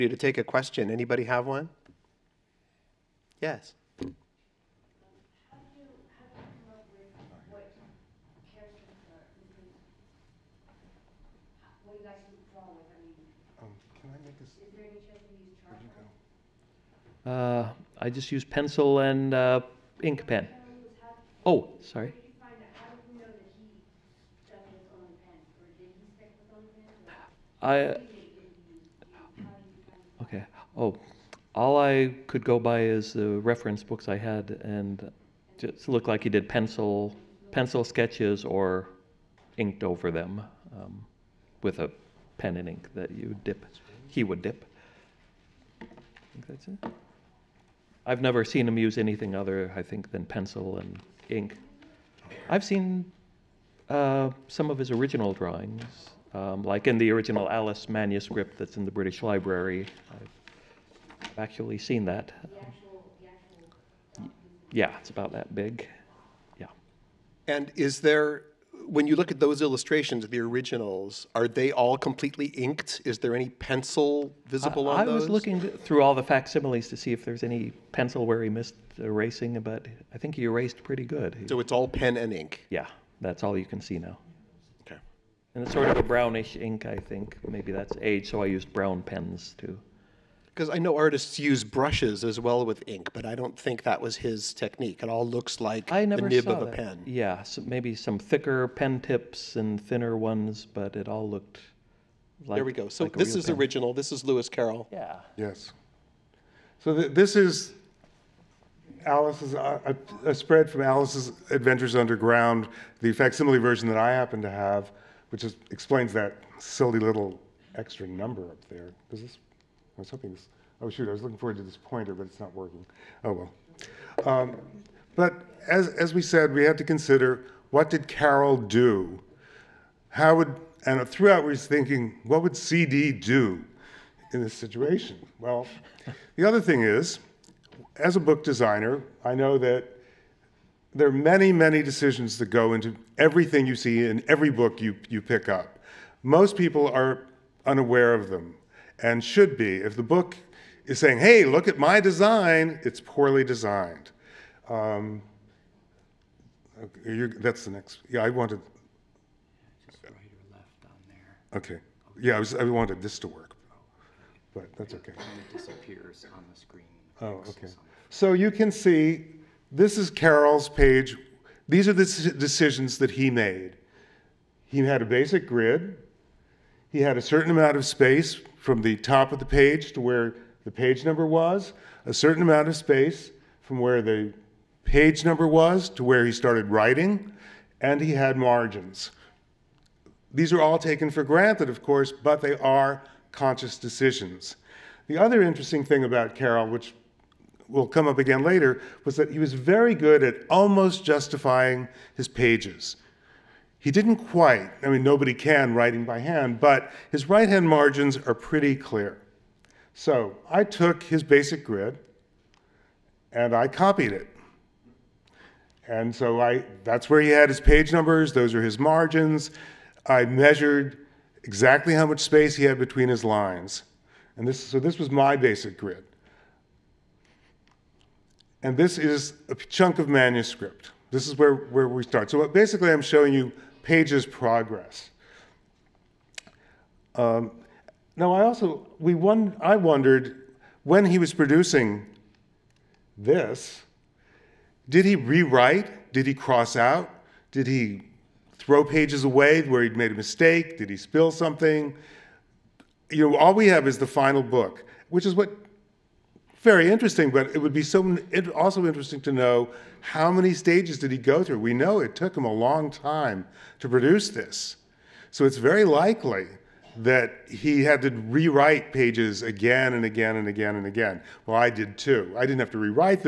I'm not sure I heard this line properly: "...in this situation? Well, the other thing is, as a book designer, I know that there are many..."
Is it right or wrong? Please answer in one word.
right.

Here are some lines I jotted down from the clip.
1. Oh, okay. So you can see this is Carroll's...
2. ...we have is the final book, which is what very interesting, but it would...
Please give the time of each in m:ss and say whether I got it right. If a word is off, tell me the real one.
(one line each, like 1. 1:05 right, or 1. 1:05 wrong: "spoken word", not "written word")
1. 2:47 right
2. 4:13 right.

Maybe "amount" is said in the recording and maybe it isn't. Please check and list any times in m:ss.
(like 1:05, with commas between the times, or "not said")
2:57, 3:02.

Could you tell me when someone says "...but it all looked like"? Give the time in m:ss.
1:40.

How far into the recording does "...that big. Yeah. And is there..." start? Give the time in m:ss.
1:05.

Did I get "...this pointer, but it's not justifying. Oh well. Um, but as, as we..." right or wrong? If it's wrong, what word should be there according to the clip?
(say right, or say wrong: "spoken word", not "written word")
wrong: "working", not "justifying".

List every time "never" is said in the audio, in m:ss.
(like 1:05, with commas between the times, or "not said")
0:48, 1:36.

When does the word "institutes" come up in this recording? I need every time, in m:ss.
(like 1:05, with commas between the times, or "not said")
not said.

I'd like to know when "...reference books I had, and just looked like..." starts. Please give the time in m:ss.
0:33.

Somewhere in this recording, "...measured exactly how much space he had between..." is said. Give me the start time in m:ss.
3:40.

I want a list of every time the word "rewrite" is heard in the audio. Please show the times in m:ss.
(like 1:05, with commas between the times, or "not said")
4:05, 4:28, 4:32.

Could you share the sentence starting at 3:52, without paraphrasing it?
So basically I'm showing you Page's progress.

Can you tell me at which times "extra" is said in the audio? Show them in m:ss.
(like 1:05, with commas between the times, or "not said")
1:57.